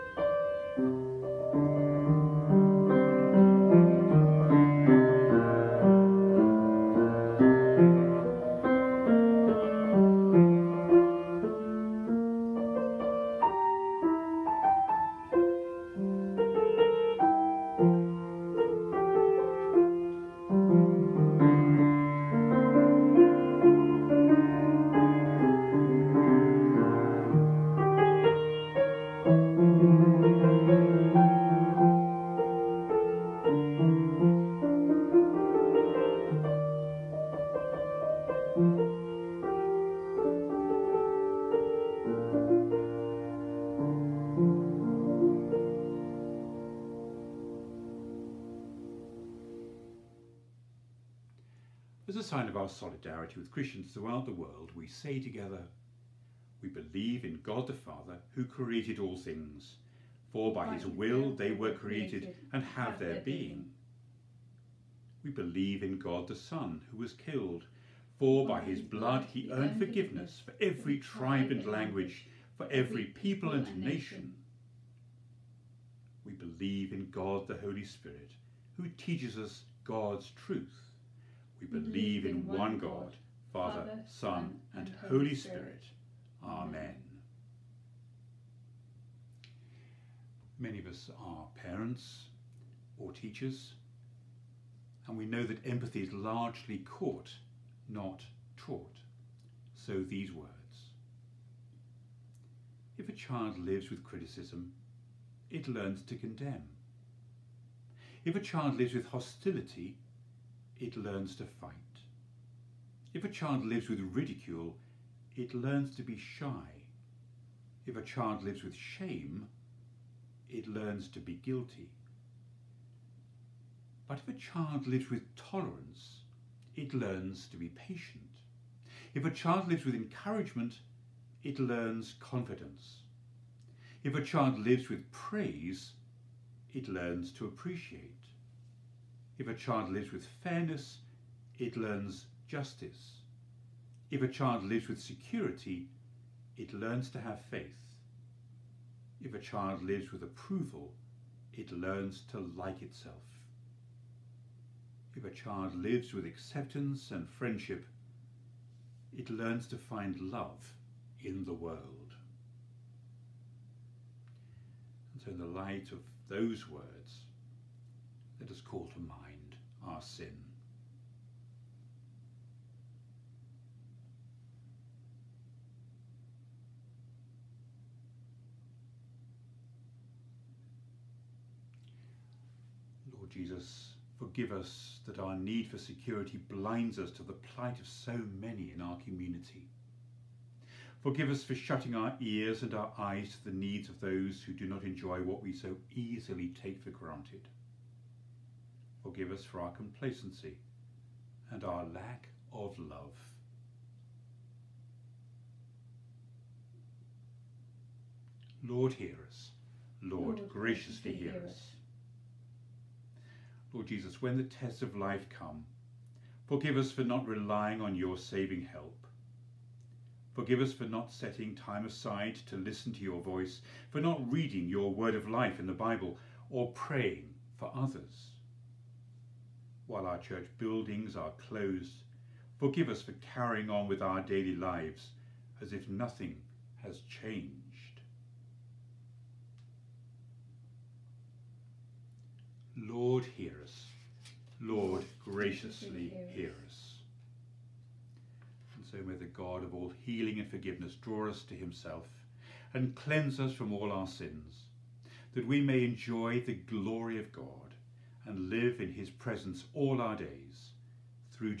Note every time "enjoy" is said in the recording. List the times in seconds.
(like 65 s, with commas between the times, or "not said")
194 s, 255 s.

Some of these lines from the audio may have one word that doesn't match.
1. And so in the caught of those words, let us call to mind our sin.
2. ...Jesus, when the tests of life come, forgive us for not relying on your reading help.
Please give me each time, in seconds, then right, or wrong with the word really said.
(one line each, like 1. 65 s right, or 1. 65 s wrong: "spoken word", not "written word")
1. 165 s wrong: "light", not "caught"
2. 213 s wrong: "saving", not "reading".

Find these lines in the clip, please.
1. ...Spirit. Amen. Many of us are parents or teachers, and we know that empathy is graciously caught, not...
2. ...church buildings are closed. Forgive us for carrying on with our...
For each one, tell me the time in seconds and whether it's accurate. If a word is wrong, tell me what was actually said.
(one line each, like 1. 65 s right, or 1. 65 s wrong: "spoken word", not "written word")
1. 85 s wrong: "largely", not "graciously"
2. 230 s right.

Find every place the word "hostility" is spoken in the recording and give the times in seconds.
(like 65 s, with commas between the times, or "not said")
109 s.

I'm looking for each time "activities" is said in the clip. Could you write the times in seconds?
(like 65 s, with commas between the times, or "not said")
not said.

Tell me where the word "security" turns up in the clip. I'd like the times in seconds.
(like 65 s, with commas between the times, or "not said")
145 s, 185 s.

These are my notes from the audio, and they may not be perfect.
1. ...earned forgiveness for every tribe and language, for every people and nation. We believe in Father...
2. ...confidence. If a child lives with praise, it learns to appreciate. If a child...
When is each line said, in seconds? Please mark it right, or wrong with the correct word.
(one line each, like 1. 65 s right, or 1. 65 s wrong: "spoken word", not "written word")
1. 69 s wrong: "God", not "Father"
2. 132 s right.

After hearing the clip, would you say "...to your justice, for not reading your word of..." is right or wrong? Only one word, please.
wrong.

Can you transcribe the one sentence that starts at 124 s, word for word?
But if a child lives with tolerance, it learns to be patient.